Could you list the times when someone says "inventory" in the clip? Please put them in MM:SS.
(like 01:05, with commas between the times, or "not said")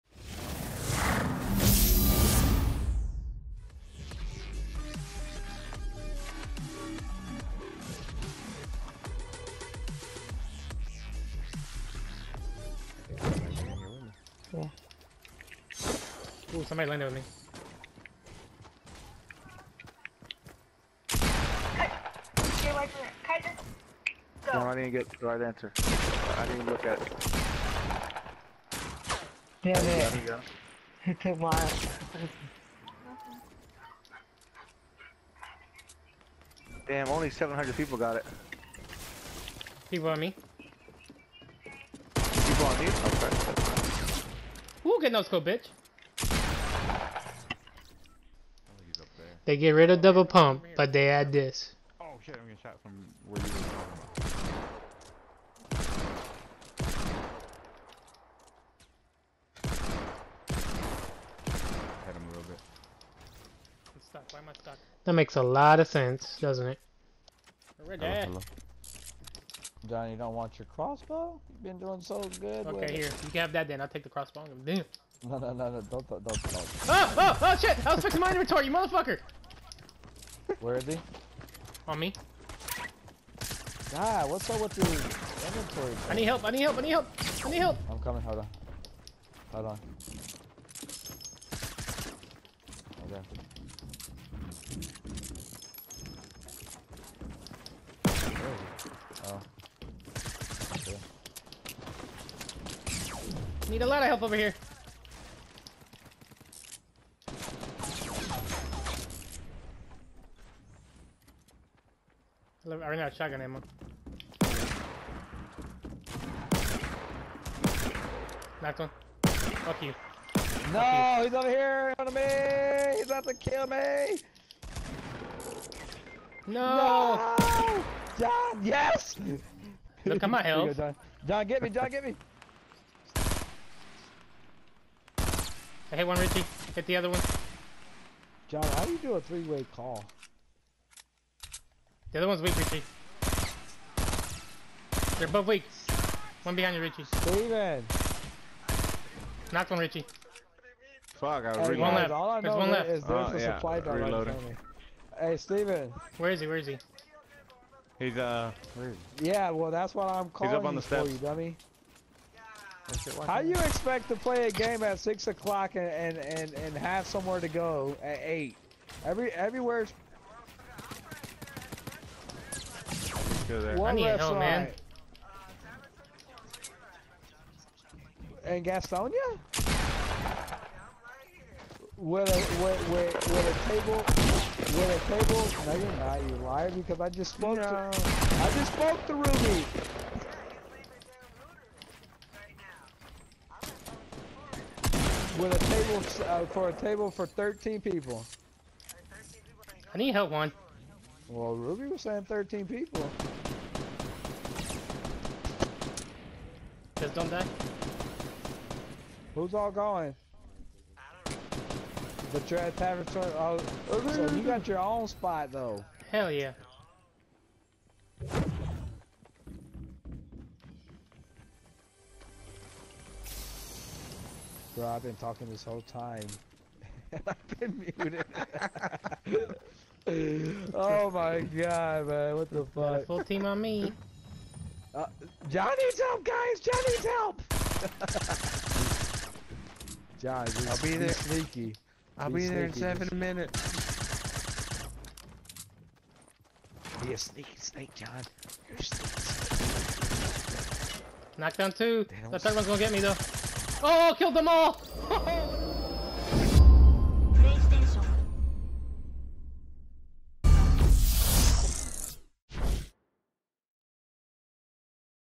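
01:18, 01:24.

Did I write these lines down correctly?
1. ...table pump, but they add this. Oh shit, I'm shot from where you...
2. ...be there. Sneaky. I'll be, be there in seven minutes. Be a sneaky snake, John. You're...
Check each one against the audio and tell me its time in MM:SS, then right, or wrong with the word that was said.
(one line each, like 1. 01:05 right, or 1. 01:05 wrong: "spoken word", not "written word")
1. 00:50 wrong: "double", not "table"
2. 04:00 right.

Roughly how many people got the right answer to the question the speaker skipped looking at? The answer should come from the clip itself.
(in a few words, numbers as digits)
700.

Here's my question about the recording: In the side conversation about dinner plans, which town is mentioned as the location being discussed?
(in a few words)
Gastonia.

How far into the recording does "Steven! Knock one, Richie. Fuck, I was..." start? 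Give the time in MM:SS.
02:27.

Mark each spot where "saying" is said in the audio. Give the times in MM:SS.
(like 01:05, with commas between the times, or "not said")
03:22.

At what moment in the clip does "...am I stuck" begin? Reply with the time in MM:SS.
01:04.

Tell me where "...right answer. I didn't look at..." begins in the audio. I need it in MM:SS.
00:25.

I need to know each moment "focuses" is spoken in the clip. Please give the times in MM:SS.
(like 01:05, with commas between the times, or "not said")
not said.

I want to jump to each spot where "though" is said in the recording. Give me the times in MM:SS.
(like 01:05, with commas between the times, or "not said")
03:35, 04:12.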